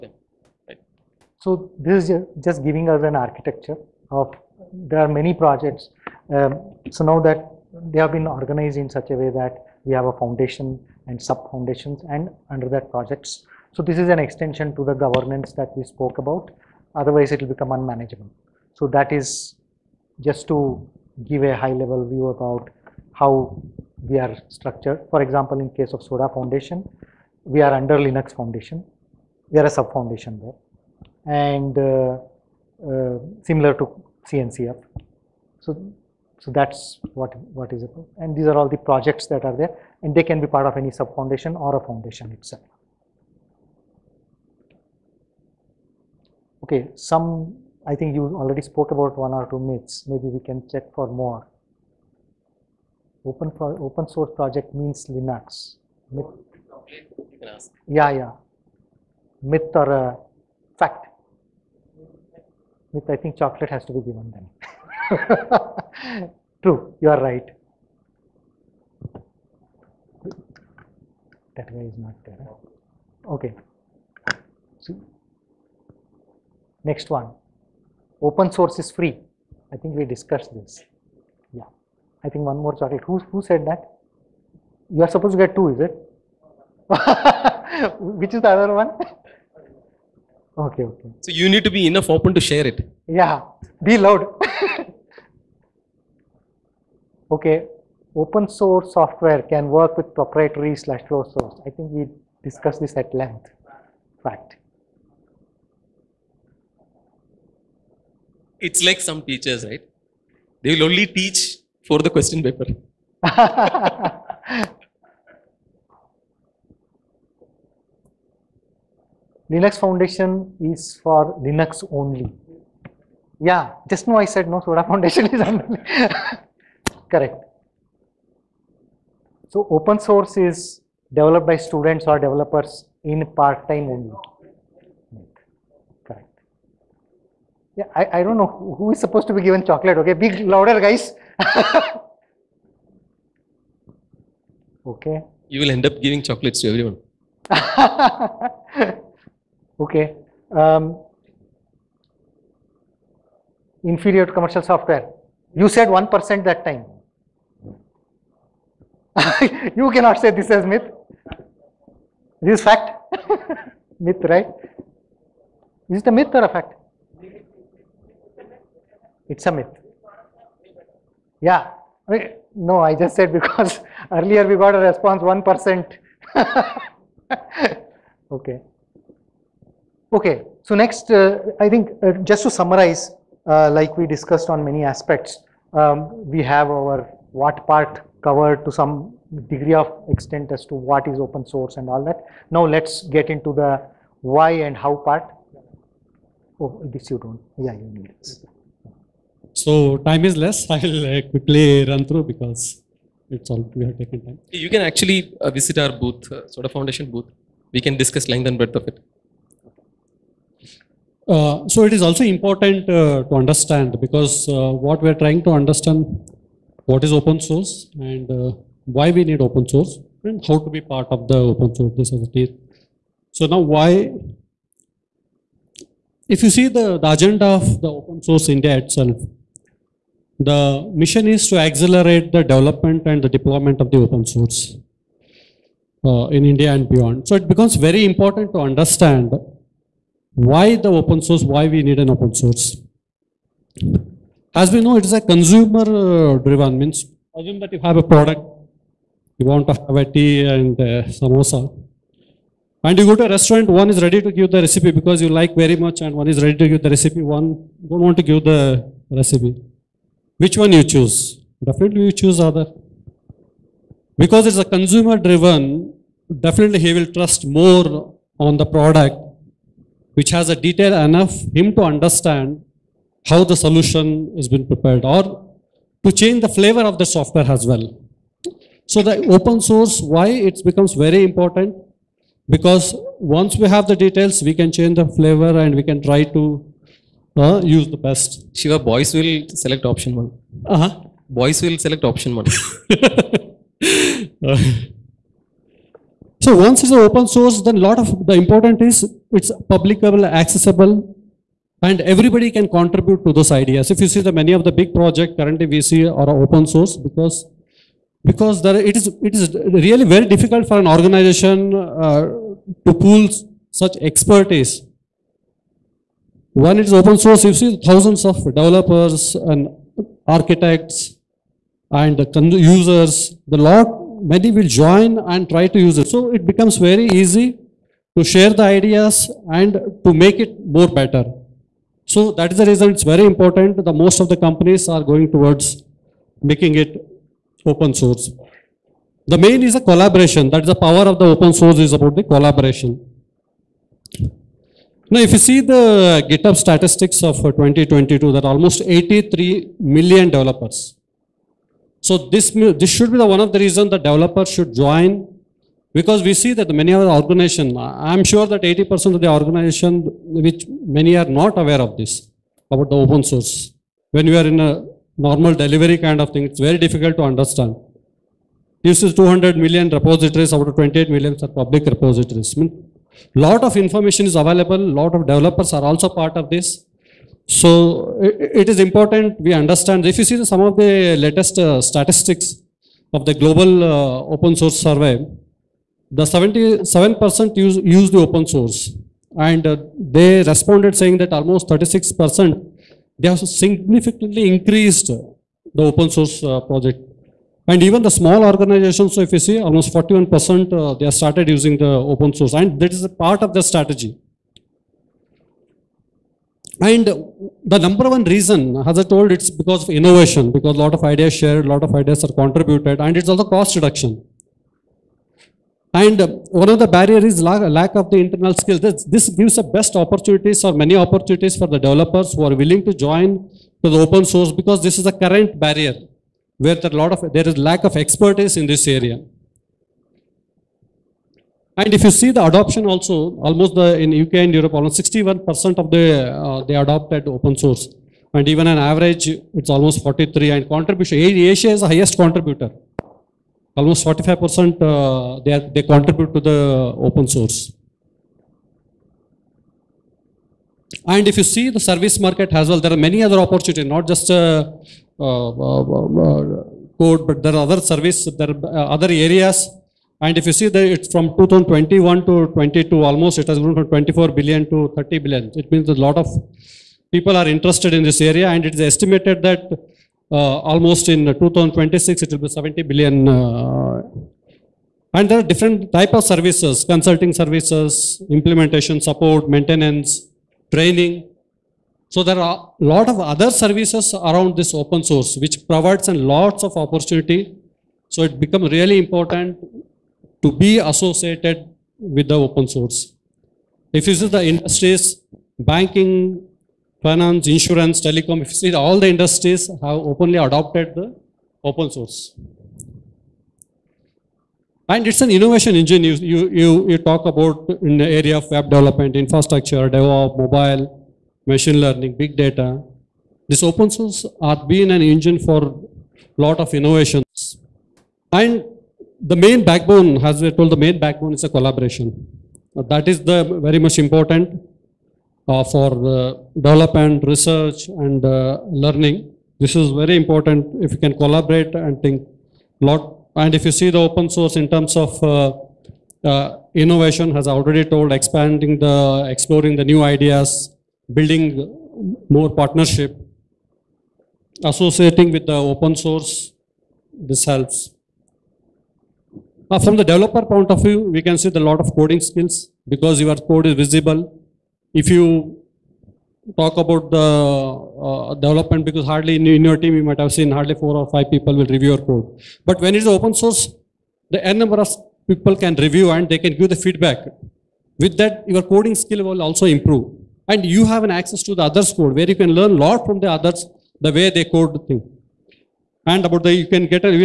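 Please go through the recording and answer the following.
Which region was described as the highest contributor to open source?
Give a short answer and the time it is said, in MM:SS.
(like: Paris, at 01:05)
Asia, at 07:21.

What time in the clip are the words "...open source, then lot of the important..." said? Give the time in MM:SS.
04:57.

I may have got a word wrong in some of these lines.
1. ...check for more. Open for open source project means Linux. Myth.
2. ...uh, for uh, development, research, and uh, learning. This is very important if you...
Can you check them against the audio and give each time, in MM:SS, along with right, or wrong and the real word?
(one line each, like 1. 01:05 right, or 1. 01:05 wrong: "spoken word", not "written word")
1. 00:50 right
2. 08:45 right.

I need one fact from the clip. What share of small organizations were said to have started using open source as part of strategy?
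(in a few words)
41%.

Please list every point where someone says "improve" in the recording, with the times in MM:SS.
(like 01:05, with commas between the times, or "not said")
09:29.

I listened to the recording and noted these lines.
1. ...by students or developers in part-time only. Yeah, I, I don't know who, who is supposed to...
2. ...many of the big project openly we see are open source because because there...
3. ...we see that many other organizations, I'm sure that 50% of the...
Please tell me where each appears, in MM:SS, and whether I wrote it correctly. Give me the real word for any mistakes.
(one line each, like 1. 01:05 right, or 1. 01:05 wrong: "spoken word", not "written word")
1. 02:11 right
2. 05:04 wrong: "currently", not "openly"
3. 05:56 wrong: "80", not "50".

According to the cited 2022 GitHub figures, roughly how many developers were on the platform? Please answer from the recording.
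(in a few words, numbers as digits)
83 million.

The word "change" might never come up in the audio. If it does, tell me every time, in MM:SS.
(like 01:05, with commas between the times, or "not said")
04:36, 04:44.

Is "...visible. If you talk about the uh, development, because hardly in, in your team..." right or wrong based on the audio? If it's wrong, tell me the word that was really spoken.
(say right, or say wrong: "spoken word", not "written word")
right.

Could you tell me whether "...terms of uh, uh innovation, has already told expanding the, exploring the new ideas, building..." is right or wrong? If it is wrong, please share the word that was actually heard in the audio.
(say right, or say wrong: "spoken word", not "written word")
right.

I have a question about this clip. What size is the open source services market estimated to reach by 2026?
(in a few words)
70 billion.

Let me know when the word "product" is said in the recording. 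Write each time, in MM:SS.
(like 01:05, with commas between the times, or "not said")
04:08, 04:28.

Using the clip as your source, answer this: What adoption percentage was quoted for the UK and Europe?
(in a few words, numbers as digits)
61%.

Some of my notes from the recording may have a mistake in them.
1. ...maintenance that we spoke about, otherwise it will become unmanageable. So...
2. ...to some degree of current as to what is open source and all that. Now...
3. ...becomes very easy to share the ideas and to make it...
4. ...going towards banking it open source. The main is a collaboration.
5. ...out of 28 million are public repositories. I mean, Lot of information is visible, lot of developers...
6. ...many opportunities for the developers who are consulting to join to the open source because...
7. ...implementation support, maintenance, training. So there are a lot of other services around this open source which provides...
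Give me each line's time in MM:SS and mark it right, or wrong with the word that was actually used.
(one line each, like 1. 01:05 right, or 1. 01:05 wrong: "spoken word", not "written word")
1. 00:14 wrong: "governance", not "maintenance"
2. 03:08 wrong: "extent", not "current"
3. 05:26 right
4. 05:35 wrong: "making", not "banking"
5. 06:10 wrong: "available", not "visible"
6. 07:00 wrong: "willing", not "consulting"
7. 07:58 right.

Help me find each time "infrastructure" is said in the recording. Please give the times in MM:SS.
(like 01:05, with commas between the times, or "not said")
08:29.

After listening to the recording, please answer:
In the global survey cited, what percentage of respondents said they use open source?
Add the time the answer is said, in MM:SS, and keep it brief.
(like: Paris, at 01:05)
77%, at 06:26.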